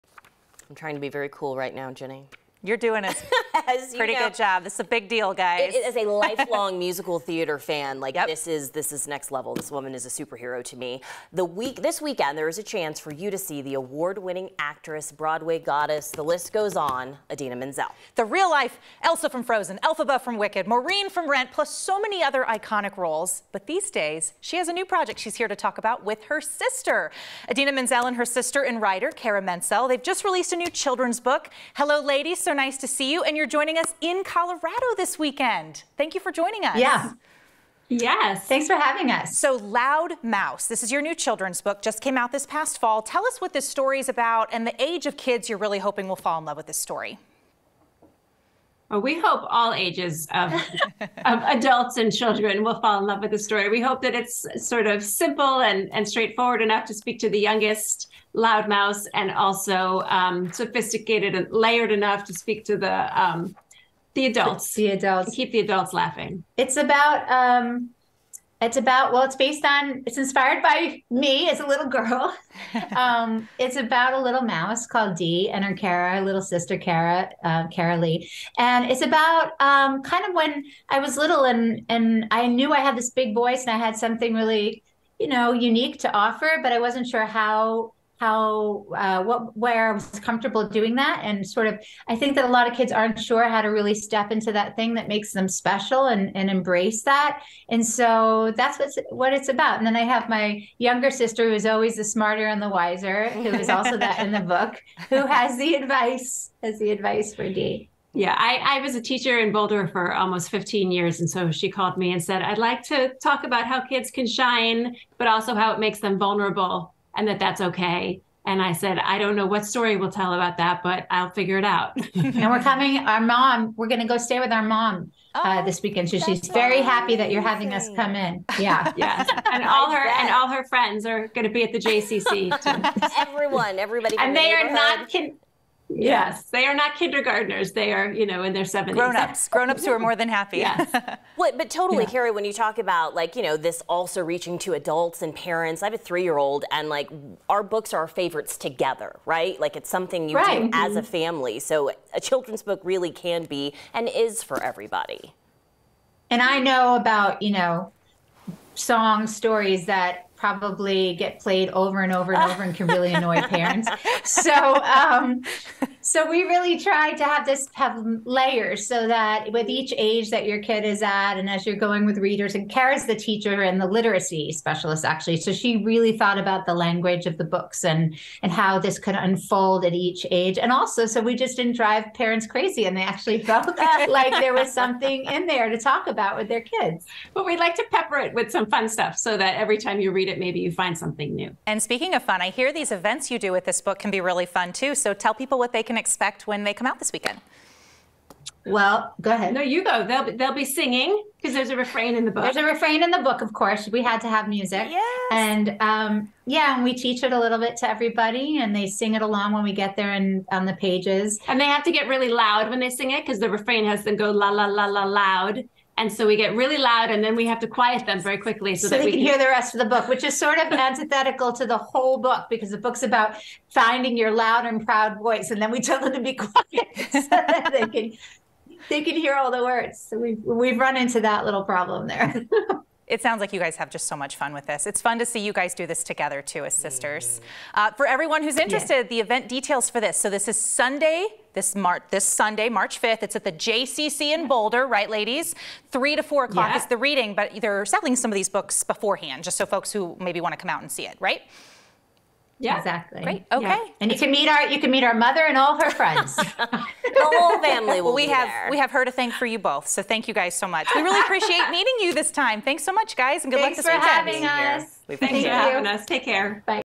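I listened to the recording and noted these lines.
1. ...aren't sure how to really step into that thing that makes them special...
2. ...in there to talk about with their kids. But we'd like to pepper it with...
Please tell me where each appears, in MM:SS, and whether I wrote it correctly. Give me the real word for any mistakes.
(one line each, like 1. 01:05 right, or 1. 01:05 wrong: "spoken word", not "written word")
1. 01:32 right
2. 03:05 right.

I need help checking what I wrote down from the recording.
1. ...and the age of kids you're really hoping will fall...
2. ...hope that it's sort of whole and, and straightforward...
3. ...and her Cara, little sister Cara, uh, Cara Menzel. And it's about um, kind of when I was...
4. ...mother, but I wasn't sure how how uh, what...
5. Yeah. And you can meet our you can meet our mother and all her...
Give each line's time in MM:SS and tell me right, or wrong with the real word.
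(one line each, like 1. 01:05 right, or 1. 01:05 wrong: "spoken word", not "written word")
1. 00:44 right
2. 00:53 wrong: "simple", not "whole"
3. 01:15 wrong: "Lee", not "Menzel"
4. 01:26 wrong: "offer", not "mother"
5. 04:13 right.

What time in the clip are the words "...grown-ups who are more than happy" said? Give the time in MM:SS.
02:19.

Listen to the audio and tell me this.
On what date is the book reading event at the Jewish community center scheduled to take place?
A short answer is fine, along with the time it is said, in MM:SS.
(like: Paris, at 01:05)
March 5th, at 04:02.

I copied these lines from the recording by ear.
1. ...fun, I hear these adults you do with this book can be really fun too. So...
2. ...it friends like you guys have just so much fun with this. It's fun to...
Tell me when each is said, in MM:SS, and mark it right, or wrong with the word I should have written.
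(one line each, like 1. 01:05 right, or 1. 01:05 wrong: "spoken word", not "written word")
1. 03:12 wrong: "events", not "adults"
2. 03:53 wrong: "sounds", not "friends".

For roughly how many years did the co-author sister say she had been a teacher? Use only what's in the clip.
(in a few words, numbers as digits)
15 years.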